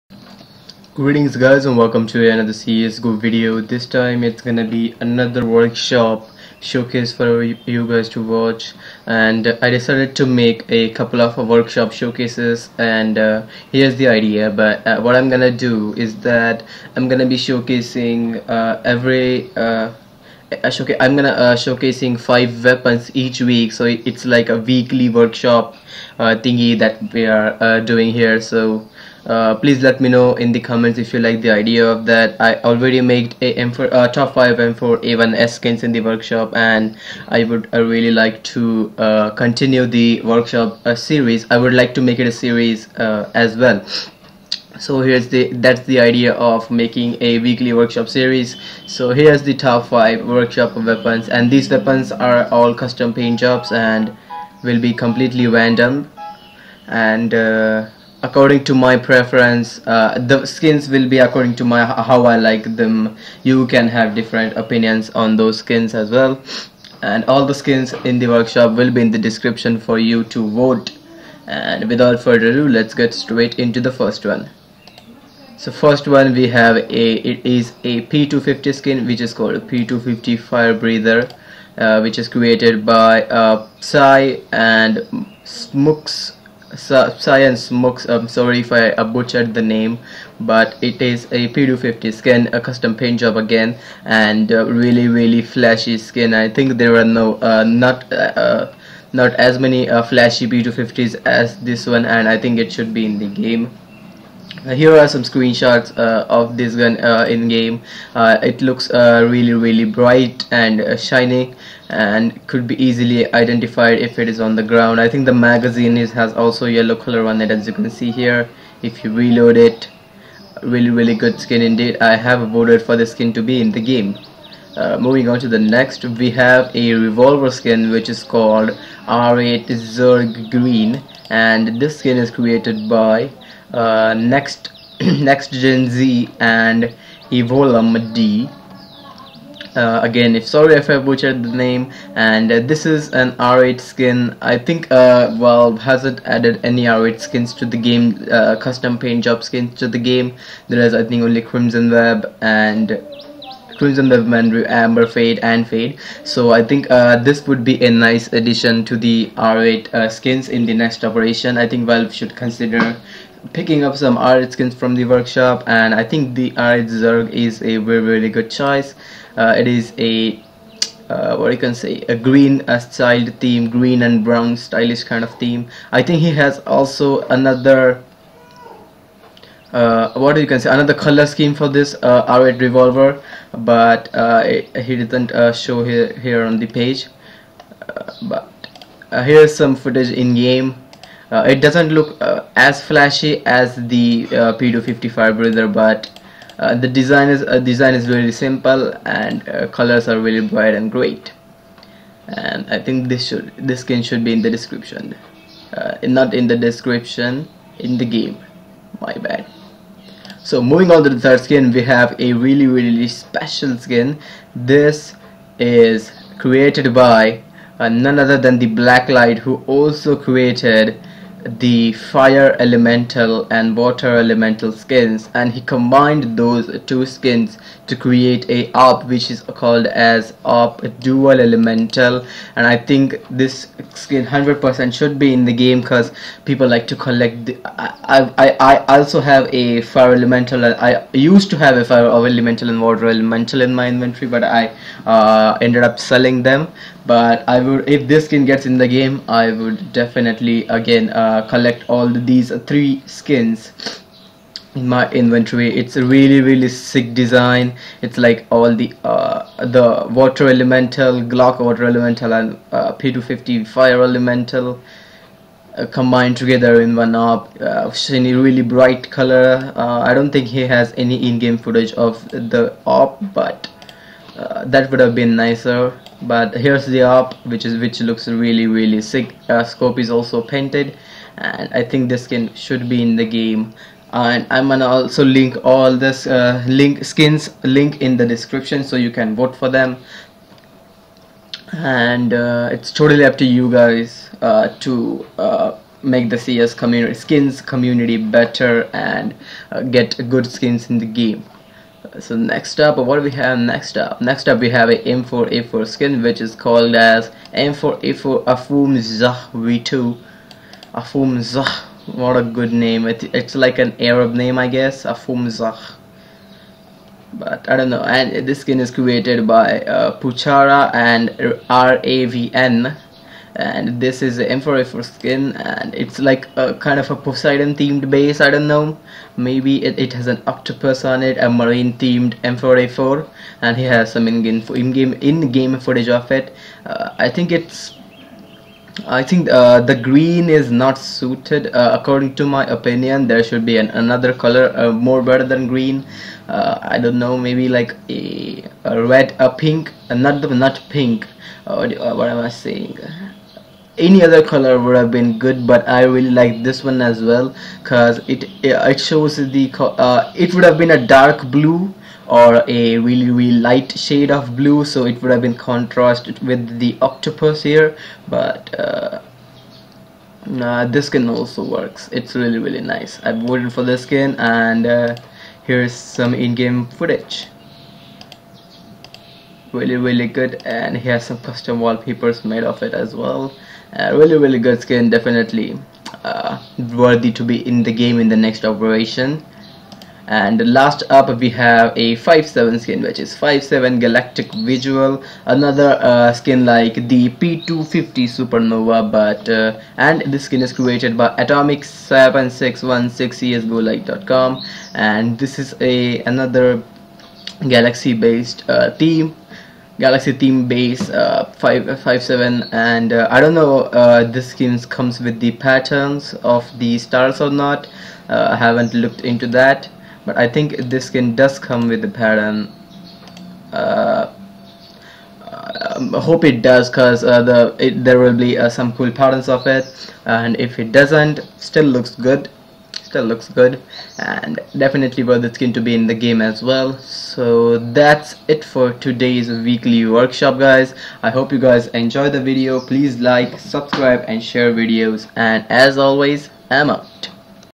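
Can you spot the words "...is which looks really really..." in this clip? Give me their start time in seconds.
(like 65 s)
277 s.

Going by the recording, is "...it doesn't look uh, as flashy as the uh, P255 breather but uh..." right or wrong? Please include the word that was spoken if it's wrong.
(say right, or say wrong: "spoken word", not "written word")
right.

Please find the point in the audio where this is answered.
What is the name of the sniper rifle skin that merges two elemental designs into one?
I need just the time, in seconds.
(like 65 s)
230 s.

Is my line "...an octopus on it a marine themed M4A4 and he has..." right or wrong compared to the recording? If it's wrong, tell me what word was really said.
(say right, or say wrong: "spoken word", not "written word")
right.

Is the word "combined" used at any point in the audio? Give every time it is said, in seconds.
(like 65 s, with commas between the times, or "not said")
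225 s, 265 s.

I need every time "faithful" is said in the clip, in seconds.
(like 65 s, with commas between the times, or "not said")
not said.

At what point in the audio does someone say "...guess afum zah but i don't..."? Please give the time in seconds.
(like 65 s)
314 s.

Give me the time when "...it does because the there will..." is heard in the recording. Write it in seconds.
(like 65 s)
426 s.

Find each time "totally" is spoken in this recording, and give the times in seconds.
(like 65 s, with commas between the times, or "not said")
292 s.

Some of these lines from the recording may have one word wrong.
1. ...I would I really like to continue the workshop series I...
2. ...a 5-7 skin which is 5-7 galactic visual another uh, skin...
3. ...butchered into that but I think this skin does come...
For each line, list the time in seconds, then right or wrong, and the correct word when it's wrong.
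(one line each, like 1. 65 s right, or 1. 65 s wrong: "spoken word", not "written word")
1. 37 s right
2. 391 s right
3. 418 s wrong: "looked", not "butchered".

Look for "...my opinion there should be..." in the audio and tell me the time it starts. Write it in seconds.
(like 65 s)
342 s.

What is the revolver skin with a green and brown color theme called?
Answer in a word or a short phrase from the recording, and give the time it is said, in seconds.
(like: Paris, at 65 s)
R8 Zerg Green, at 129 s.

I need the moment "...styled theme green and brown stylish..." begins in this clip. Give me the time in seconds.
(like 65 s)
172 s.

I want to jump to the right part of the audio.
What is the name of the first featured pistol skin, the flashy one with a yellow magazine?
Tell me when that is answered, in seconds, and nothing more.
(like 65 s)
79 s.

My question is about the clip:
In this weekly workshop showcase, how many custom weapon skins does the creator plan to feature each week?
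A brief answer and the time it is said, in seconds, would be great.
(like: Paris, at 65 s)
5, at 22 s.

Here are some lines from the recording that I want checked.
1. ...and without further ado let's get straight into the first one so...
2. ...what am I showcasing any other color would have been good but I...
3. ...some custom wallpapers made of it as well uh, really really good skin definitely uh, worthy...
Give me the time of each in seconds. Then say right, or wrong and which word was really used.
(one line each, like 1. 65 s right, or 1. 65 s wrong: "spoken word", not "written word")
1. 71 s right
2. 352 s wrong: "saying", not "showcasing"
3. 381 s right.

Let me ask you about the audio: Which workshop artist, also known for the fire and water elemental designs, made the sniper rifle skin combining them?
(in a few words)
Blacklight.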